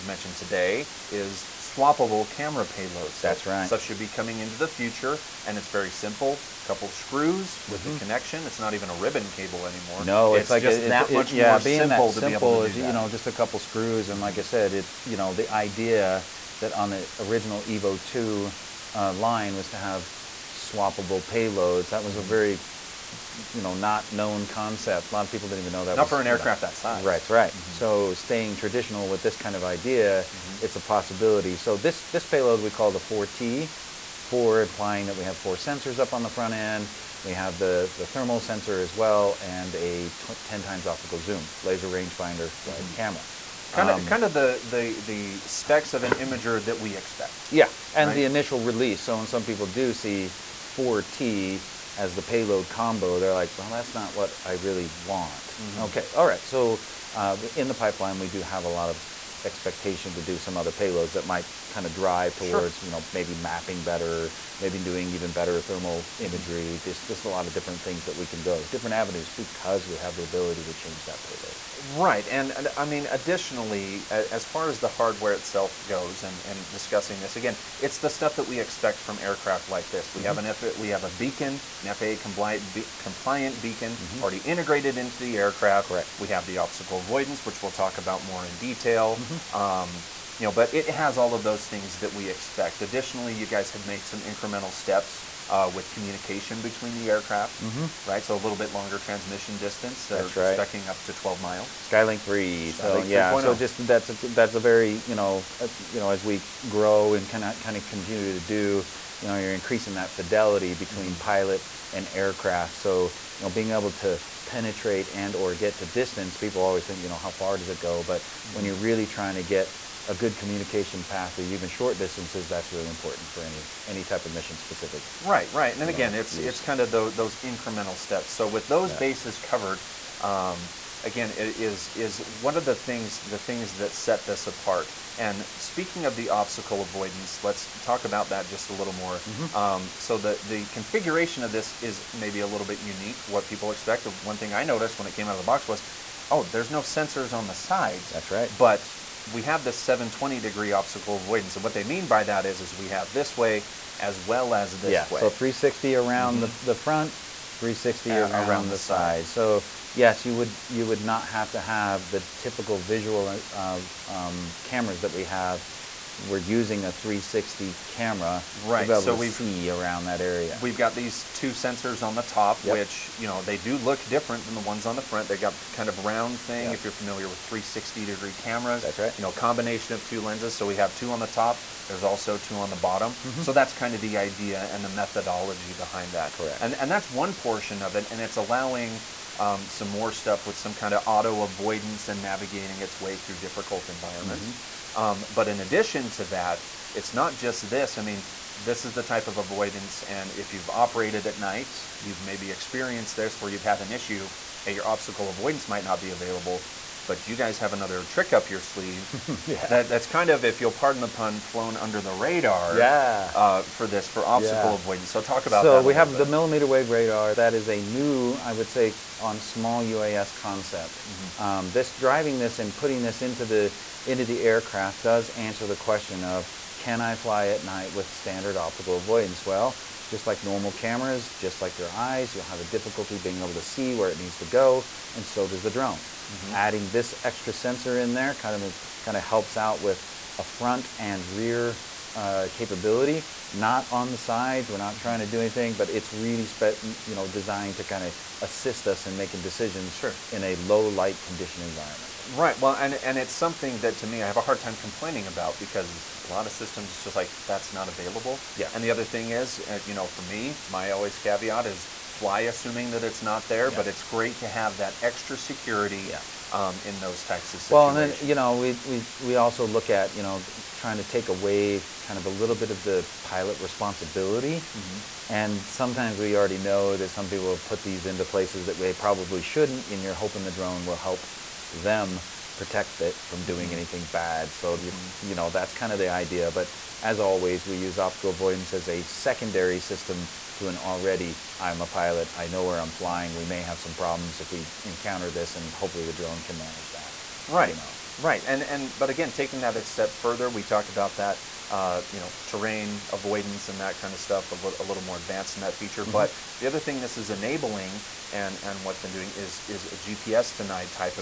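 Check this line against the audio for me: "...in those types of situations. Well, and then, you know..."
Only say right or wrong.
right.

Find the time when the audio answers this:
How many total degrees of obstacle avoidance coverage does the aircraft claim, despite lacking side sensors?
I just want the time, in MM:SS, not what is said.
02:29.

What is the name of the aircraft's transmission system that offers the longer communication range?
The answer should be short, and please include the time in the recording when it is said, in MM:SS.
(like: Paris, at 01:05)
Skylink 3, at 01:41.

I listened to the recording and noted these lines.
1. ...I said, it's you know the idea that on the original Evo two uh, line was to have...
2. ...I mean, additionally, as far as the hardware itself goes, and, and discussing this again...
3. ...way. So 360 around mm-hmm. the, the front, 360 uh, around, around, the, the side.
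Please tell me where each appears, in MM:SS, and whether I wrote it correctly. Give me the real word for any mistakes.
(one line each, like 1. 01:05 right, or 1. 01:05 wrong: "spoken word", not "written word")
1. 00:14 right
2. 01:12 right
3. 02:35 right.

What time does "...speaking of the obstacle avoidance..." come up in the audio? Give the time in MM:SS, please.
02:15.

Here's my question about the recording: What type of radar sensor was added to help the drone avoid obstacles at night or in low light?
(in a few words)
millimeter wave radar.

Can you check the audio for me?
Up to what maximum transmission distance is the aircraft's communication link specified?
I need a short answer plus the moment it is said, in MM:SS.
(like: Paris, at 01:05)
12 miles, at 01:41.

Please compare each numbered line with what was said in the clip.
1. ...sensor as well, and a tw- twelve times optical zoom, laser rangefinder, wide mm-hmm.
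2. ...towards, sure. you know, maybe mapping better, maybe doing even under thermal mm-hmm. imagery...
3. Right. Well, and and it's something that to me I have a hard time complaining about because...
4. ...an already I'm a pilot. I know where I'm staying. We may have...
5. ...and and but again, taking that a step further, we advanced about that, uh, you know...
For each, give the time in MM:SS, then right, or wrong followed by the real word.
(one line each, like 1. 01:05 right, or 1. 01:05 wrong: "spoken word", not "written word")
1. 00:38 wrong: "ten", not "twelve"
2. 01:02 wrong: "better", not "under"
3. 04:12 right
4. 04:50 wrong: "flying", not "staying"
5. 04:58 wrong: "talked", not "advanced".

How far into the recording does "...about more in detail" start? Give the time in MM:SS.
01:27.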